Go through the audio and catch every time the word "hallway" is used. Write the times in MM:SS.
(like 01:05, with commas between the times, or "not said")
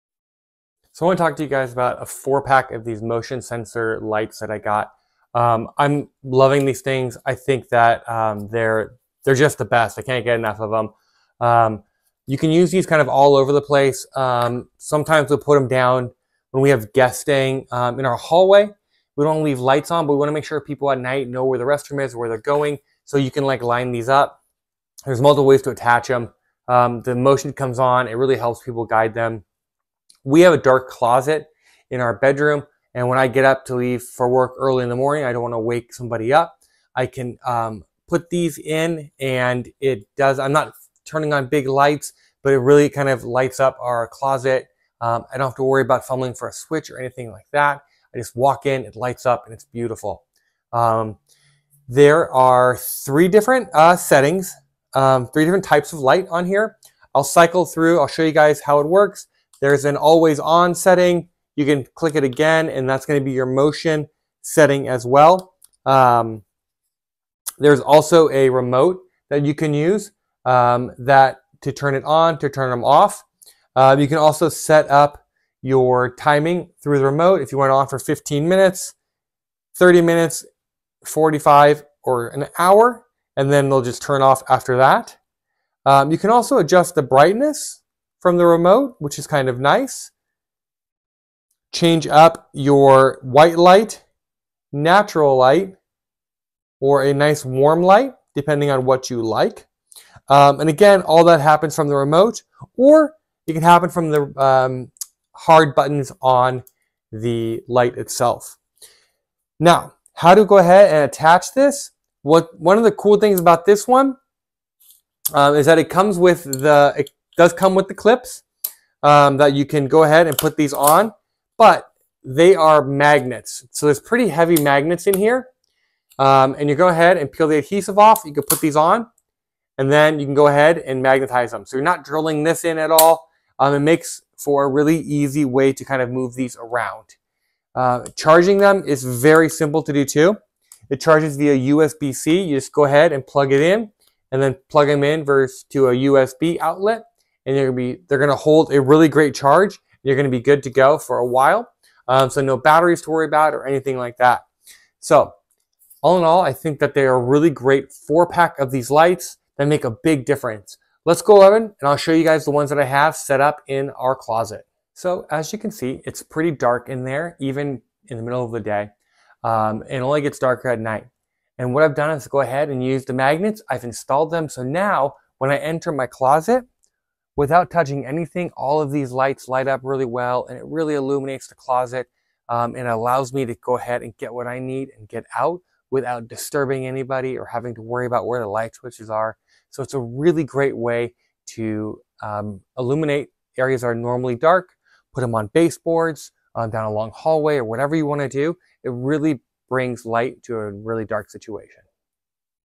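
00:18, 03:17.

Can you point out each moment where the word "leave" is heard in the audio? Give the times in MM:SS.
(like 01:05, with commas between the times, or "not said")
00:19, 00:33.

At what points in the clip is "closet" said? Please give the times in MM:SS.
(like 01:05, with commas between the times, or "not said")
00:30, 00:44, 02:44, 02:56, 03:01.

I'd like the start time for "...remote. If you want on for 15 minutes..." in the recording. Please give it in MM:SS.
01:17.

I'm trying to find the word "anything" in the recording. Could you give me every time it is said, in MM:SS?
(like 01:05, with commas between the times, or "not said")
00:46, 02:33, 02:58.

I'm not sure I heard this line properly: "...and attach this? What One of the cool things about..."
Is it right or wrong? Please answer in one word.
right.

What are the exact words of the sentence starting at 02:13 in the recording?
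Um, it makes for a really easy way to kind of move these around.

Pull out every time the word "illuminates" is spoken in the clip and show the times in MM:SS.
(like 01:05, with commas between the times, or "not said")
03:00, 03:12.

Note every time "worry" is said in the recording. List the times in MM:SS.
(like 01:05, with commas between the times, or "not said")
00:45, 02:33, 03:07.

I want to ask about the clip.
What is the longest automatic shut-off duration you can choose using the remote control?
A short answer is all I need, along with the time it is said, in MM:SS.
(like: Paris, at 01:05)
an hour, at 01:22.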